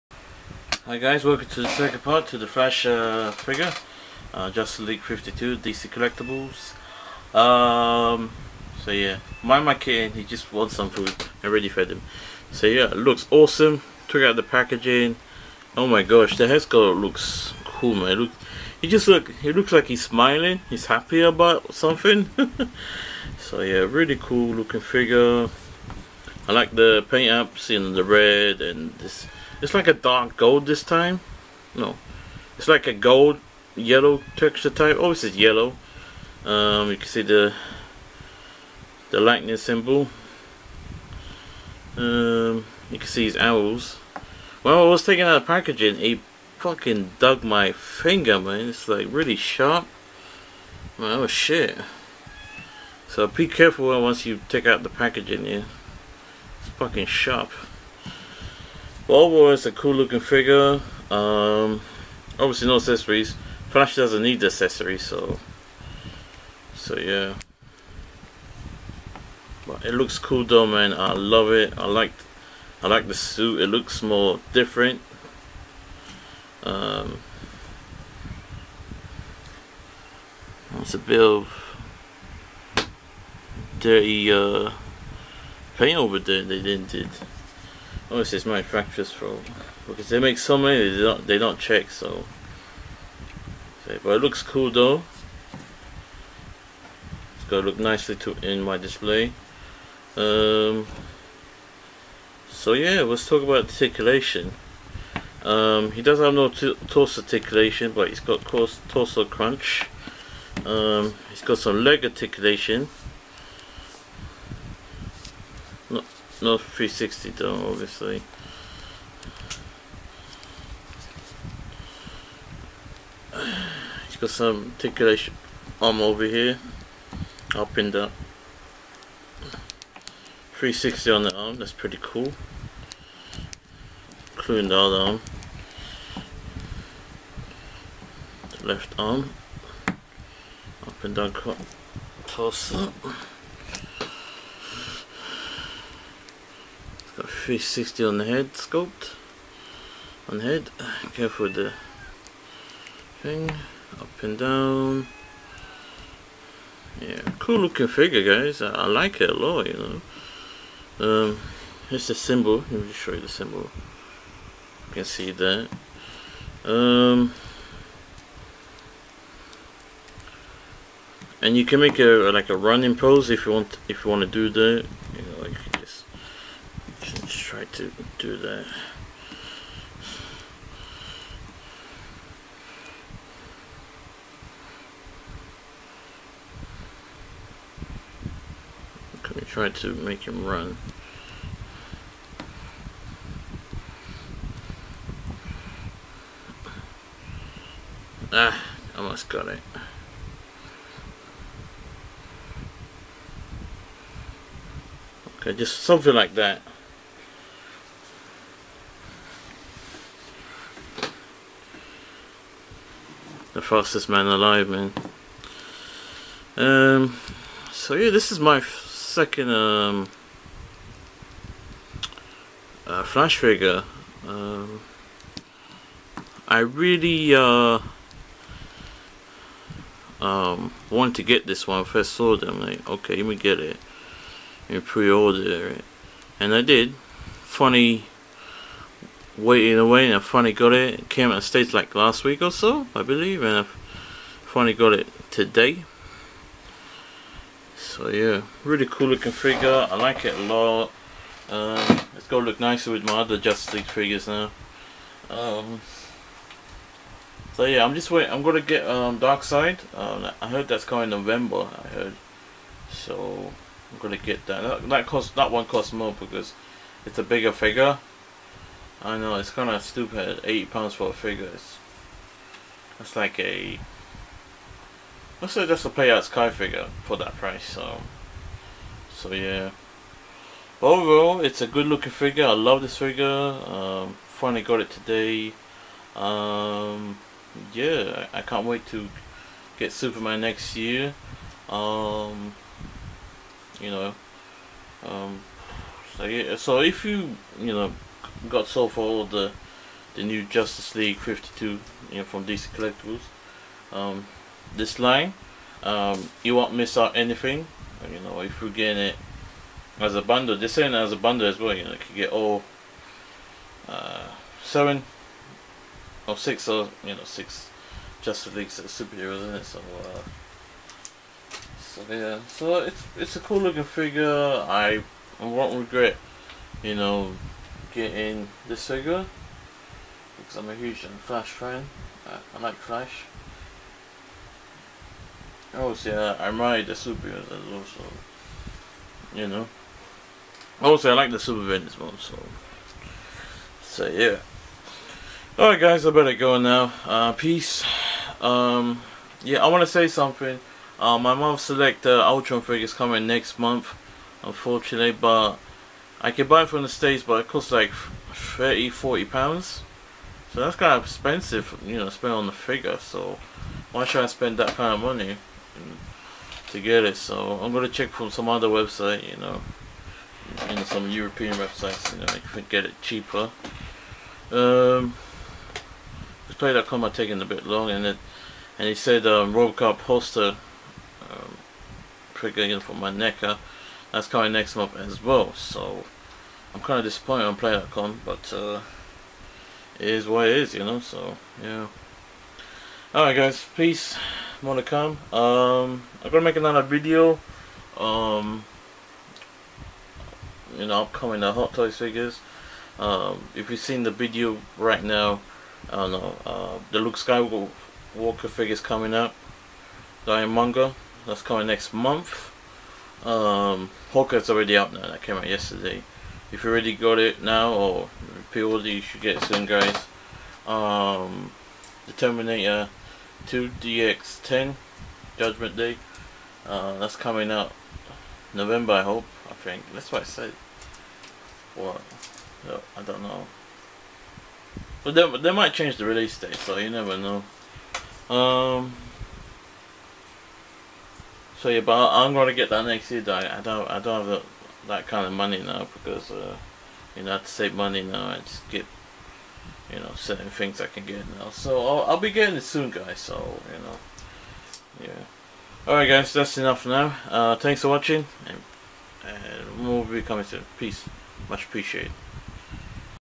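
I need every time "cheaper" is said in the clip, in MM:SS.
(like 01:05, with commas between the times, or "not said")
06:13.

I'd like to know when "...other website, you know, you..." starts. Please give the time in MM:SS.
06:08.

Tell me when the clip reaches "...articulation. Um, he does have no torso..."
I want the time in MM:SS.
01:43.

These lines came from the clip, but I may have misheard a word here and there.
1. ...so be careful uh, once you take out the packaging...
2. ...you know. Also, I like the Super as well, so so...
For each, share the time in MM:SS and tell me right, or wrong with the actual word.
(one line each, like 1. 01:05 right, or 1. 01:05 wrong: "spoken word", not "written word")
1. 00:53 right
2. 05:39 right.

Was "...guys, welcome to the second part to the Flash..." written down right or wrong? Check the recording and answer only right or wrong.
right.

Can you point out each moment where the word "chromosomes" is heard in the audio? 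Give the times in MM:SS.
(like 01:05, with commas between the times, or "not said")
not said.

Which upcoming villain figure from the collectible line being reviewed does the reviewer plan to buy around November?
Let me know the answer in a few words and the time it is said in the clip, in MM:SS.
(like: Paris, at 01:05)
Darkseid, at 04:19.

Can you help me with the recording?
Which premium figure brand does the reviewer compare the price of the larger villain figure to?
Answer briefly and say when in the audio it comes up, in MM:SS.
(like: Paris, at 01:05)
Play Arts Kai, at 04:35.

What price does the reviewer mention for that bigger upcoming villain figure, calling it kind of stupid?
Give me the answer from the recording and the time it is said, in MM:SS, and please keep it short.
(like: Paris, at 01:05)
8 pounds, at 04:30.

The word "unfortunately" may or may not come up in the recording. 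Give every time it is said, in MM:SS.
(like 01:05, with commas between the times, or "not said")
05:54.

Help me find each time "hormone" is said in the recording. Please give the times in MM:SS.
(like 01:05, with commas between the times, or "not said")
not said.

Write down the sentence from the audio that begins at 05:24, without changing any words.
I, I won't regret, you know, getting this figure because I'm a huge Flash fan.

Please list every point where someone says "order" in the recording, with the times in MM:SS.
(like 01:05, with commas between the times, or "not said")
03:54, 06:58.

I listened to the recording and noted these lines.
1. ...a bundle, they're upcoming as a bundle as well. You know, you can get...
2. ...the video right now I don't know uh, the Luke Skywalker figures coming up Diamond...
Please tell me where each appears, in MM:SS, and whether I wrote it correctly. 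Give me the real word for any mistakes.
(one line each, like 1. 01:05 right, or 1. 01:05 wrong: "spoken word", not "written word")
1. 05:10 wrong: "selling", not "upcoming"
2. 06:44 right.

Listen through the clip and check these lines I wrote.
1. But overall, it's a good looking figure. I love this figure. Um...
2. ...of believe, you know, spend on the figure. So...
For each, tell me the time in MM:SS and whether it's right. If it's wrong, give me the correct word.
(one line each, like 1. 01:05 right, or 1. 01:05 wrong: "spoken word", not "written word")
1. 04:40 right
2. 06:00 wrong: "expensive", not "believe".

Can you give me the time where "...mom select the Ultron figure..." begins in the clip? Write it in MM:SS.
05:51.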